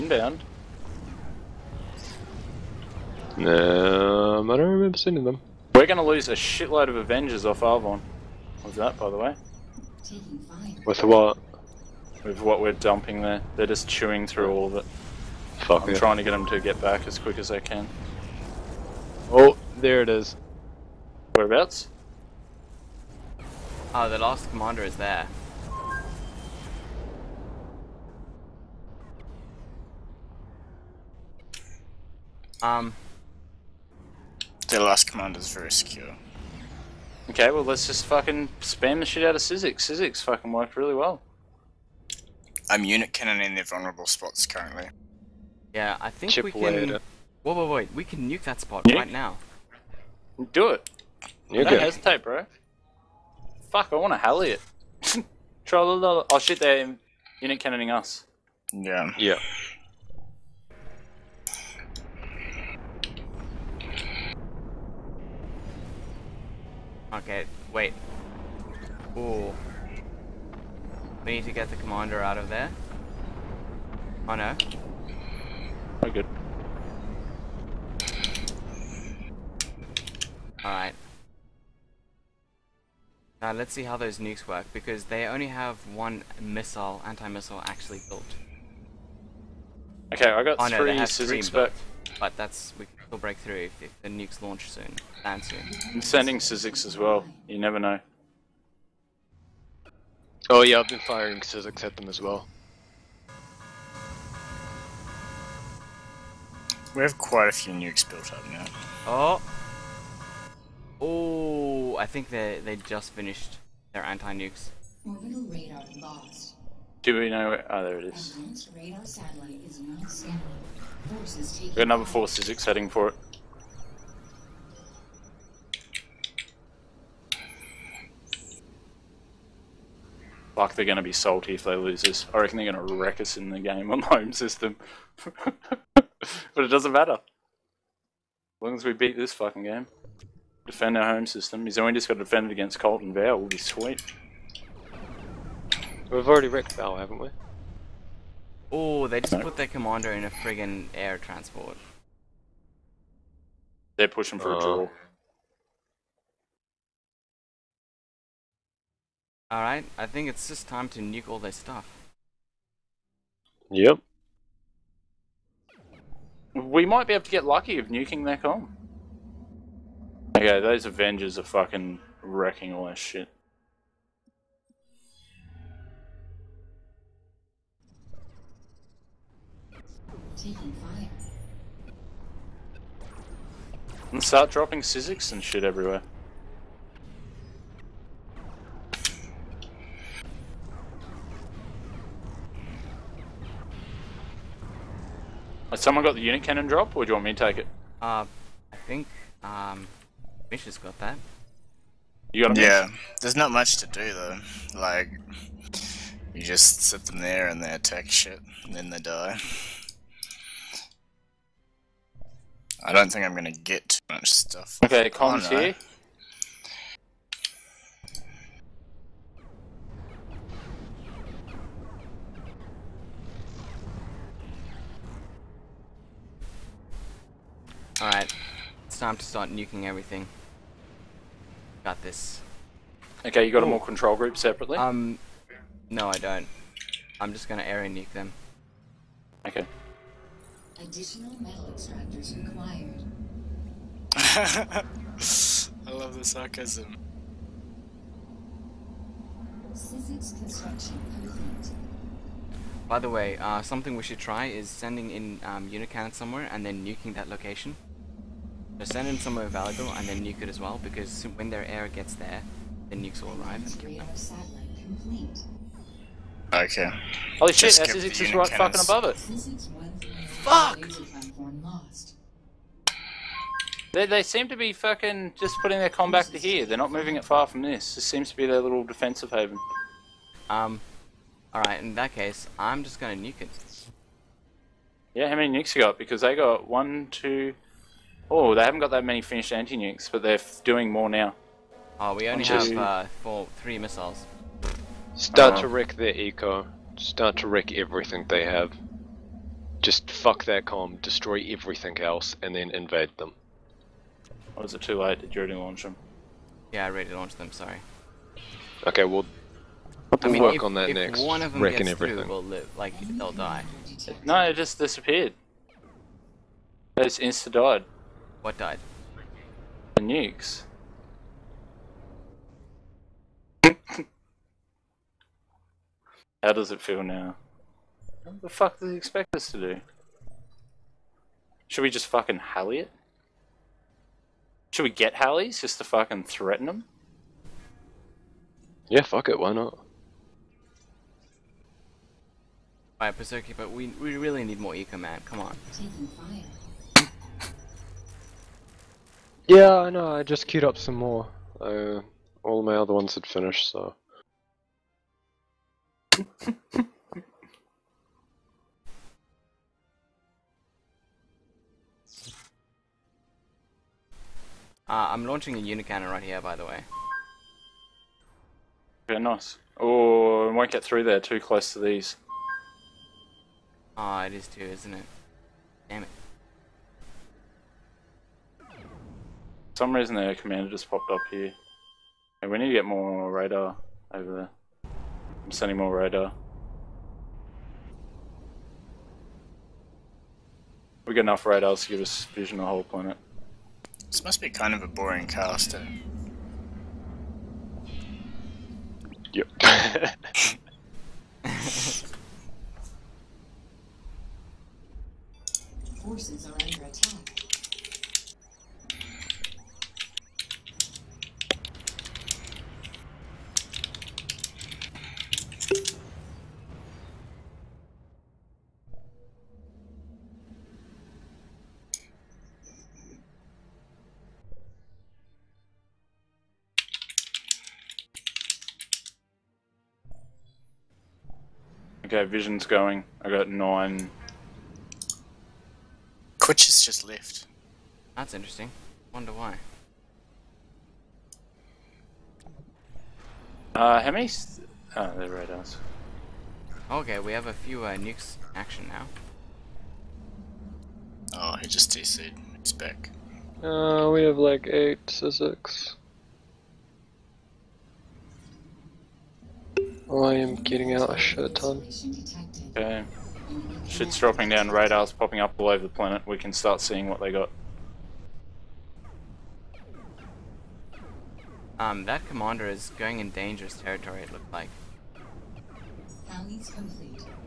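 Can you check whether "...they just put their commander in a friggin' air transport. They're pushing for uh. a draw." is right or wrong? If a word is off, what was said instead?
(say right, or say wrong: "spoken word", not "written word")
right.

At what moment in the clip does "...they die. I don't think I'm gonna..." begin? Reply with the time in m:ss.
3:28.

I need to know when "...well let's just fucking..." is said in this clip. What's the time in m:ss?
0:37.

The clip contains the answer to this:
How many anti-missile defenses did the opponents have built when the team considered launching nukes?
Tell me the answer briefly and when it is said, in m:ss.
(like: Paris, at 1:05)
1, at 1:25.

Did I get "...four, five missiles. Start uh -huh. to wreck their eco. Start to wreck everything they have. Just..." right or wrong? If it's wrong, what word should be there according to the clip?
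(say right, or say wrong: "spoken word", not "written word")
wrong: "three", not "five".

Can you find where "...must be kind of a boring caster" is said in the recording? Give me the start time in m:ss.
6:34.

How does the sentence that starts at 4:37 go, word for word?
This seems to be their little defensive haven.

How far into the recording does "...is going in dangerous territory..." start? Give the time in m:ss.
7:52.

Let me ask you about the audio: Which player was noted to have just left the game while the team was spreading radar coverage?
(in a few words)
Quitch.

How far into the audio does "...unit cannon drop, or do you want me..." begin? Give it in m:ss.
3:16.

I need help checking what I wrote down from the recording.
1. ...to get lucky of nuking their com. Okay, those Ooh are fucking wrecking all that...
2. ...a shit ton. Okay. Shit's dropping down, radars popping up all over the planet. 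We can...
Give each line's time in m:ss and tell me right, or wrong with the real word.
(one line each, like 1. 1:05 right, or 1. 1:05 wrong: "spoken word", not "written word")
1. 2:47 wrong: "Avengers", not "Ooh"
2. 7:41 right.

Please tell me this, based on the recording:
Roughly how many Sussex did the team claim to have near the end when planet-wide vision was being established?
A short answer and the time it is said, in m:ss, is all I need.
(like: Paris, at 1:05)
8, at 7:34.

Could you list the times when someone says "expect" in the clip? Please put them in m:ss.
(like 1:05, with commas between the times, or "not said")
5:28.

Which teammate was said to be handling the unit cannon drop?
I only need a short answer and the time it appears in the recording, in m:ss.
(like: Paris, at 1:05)
Mish, at 3:20.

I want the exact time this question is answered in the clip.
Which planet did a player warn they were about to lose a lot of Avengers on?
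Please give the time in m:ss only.
0:07.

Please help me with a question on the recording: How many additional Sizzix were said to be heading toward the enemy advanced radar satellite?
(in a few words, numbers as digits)
4.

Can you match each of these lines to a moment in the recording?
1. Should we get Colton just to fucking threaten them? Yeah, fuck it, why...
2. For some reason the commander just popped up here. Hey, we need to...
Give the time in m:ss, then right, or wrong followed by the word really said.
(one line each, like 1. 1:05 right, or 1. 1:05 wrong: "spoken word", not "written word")
1. 5:34 wrong: "Halleys", not "Colton"
2. 6:18 right.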